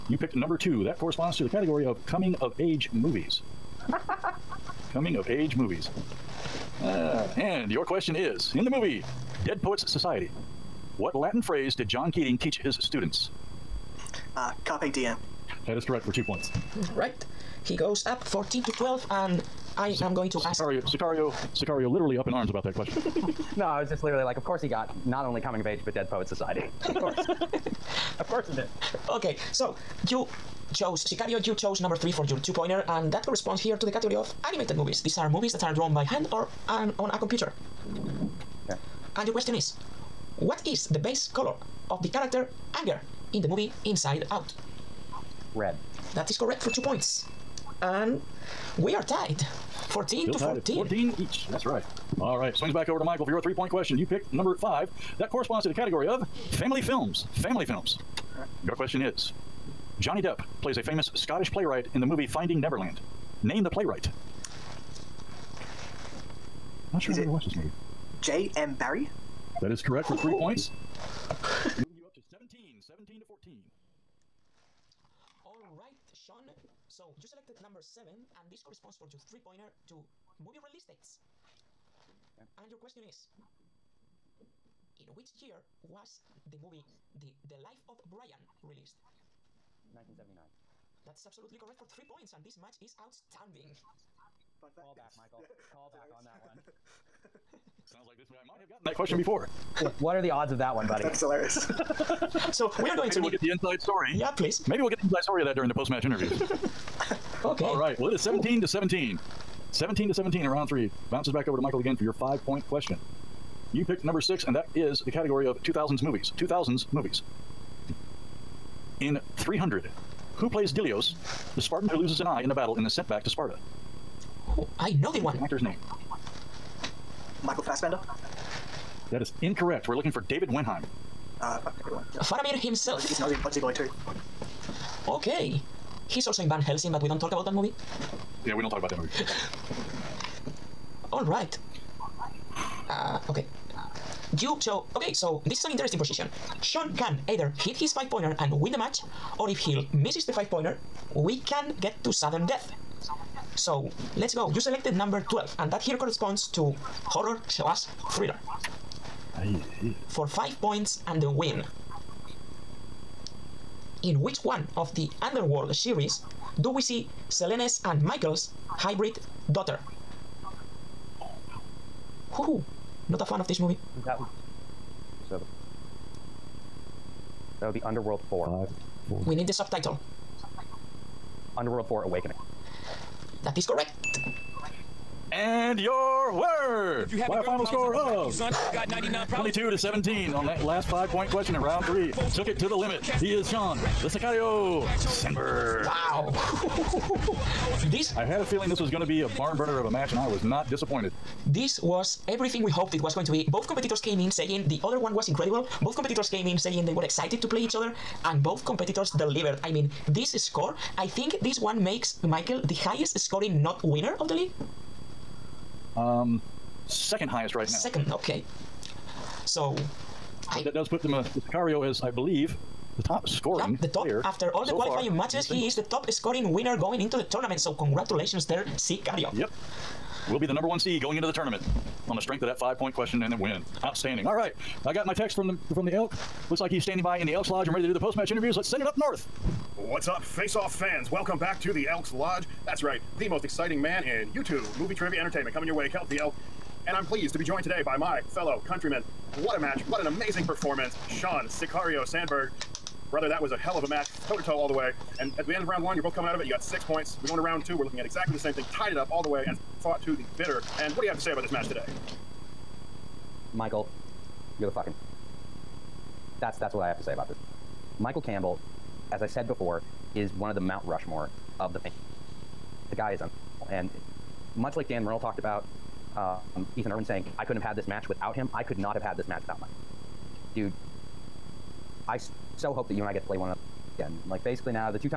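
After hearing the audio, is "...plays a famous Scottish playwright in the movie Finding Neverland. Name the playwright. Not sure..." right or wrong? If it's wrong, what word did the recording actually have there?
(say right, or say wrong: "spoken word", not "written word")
right.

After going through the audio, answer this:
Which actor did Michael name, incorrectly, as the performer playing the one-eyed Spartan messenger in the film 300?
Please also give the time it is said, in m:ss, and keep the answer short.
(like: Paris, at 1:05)
Michael Fassbender, at 2:07.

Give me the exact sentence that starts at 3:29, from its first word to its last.
I mean, this score, I think this one makes Michael the highest scoring not winner of the league.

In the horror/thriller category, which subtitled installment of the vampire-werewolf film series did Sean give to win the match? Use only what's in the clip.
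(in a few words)
Underworld 4 Awakening.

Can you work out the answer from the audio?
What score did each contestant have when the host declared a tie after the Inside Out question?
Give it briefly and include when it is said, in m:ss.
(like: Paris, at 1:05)
14, at 0:50.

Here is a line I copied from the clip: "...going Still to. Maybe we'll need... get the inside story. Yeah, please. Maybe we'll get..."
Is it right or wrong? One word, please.
wrong.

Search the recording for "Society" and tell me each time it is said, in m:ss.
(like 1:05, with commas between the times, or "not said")
0:09, 0:26.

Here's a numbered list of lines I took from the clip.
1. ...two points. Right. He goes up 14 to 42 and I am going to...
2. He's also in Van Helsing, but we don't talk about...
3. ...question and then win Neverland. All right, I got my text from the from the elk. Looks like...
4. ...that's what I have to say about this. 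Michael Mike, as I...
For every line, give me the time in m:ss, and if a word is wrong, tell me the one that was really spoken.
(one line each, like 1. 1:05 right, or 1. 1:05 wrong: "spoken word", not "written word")
1. 0:16 wrong: "12", not "42"
2. 2:16 right
3. 3:52 wrong: "Outstanding", not "Neverland"
4. 4:26 wrong: "Campbell", not "Mike".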